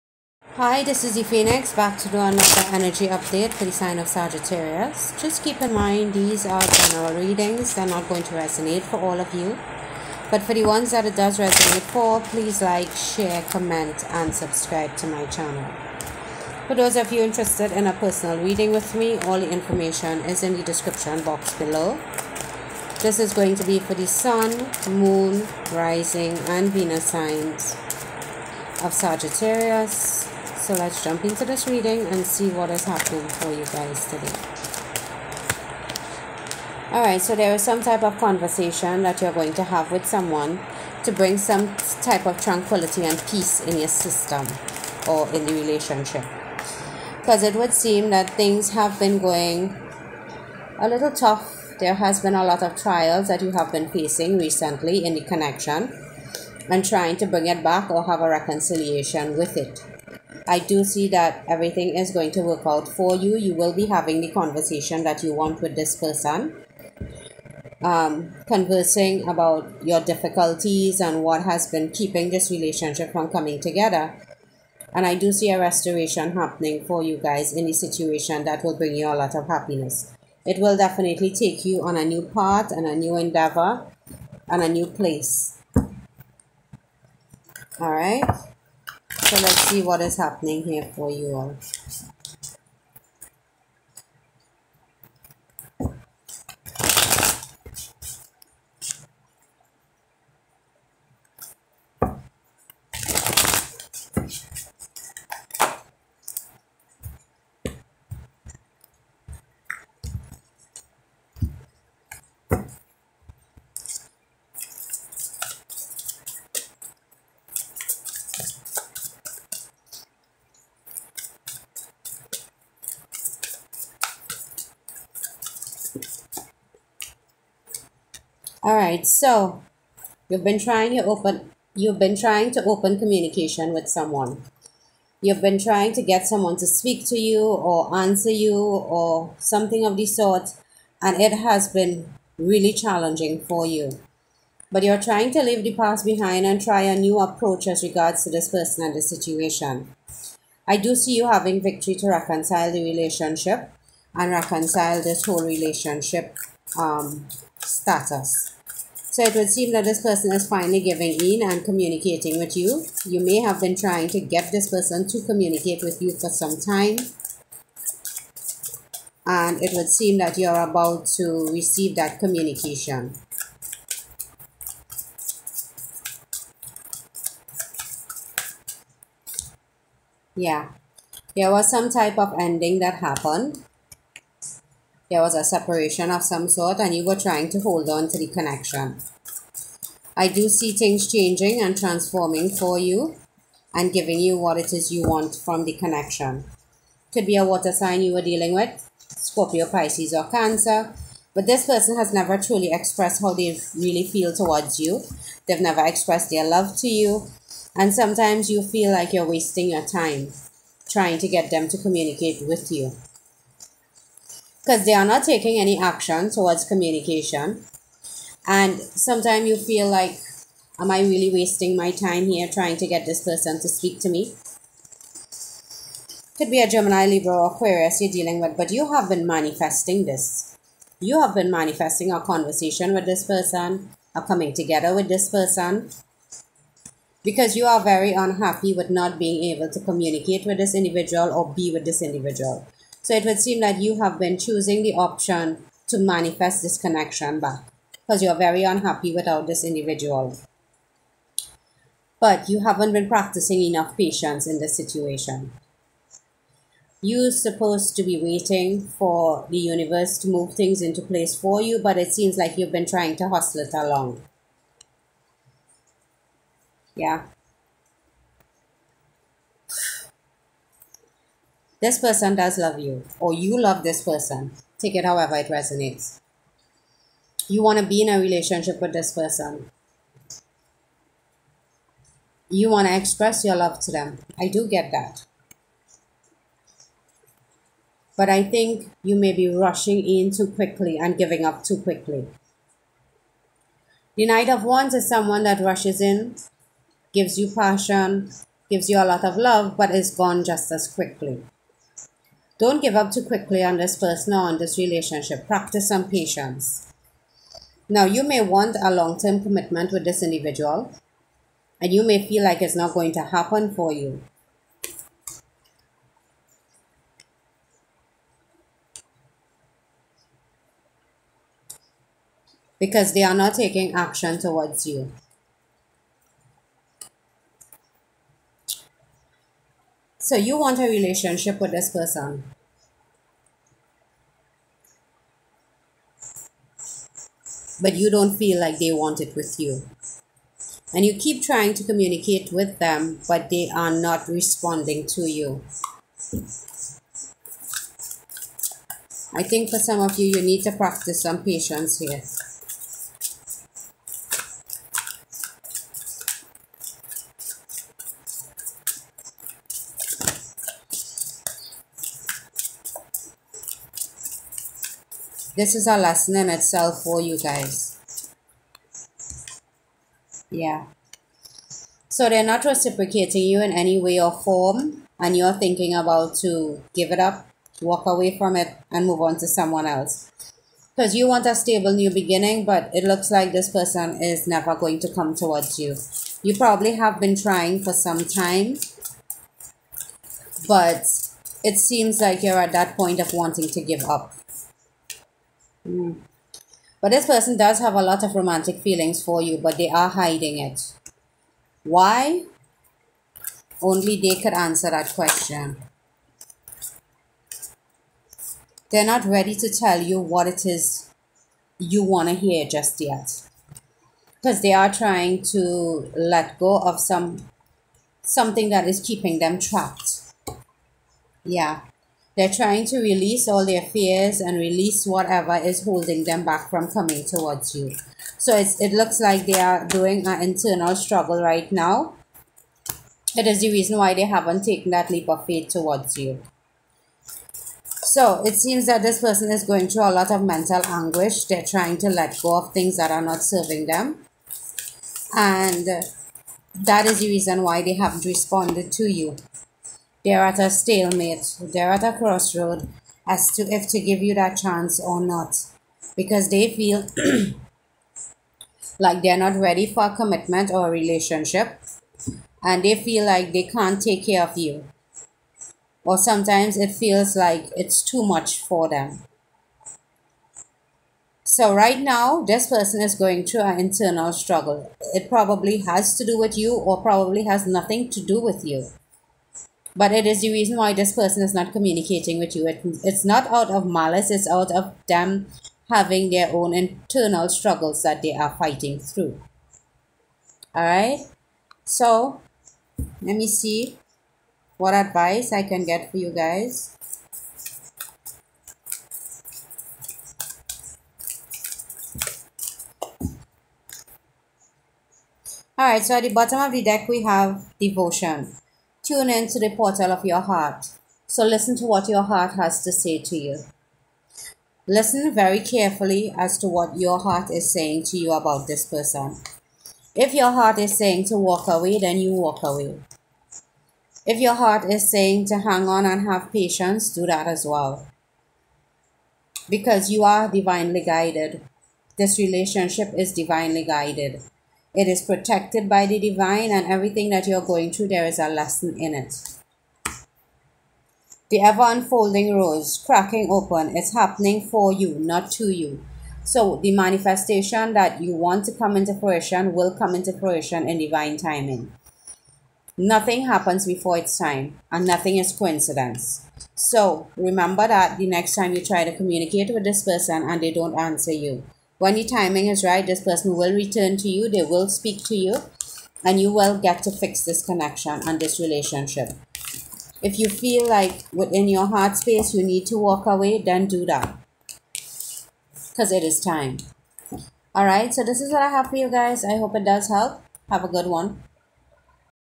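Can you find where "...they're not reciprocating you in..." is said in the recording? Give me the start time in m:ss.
6:12.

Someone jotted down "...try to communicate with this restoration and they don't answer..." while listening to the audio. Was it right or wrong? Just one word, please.
wrong.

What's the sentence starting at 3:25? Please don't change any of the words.
They've never expressed their love to you.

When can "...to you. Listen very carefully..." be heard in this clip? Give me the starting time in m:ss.
8:33.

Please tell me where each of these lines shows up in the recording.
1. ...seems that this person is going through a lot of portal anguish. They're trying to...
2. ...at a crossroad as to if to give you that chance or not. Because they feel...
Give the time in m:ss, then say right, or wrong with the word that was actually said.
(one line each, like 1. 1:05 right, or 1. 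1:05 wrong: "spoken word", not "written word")
1. 7:18 wrong: "mental", not "portal"
2. 7:31 right.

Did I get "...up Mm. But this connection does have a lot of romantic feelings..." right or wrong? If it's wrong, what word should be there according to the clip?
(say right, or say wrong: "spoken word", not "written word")
wrong: "person", not "connection".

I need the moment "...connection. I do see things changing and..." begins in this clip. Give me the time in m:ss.
3:08.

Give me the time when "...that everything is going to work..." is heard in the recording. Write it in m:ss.
1:01.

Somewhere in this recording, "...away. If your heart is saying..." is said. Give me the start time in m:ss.
8:42.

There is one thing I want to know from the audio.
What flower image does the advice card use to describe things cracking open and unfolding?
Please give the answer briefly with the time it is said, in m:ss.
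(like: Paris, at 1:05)
rose, at 9:02.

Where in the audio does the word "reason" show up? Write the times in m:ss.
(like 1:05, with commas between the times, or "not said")
7:13, 7:27, 8:00.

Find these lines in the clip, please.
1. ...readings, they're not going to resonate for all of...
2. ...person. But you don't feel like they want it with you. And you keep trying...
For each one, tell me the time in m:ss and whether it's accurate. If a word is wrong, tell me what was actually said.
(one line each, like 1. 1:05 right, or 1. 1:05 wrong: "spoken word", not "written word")
1. 0:07 right
2. 5:31 right.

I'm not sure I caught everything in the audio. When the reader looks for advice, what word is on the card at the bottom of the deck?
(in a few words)
devotion.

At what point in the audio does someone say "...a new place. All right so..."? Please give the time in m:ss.
1:24.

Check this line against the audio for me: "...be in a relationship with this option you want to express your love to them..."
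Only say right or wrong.
wrong.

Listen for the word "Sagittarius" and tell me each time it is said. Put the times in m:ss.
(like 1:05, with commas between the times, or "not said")
0:04, 0:28.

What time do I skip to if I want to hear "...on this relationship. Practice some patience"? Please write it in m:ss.
5:04.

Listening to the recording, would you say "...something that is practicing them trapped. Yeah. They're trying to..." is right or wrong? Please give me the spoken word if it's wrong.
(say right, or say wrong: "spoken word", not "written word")
wrong: "keeping", not "practicing".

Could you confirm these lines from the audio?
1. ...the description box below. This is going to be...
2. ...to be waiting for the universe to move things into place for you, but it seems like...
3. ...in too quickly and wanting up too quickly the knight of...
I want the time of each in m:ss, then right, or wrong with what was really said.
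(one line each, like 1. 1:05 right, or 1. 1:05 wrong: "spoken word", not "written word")
1. 0:20 right
2. 4:17 right
3. 4:50 wrong: "giving", not "wanting".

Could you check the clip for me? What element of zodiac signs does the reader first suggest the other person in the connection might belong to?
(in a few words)
water.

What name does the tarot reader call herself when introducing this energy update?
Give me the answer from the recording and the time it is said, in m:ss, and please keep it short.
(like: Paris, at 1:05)
the Phoenix, at 0:01.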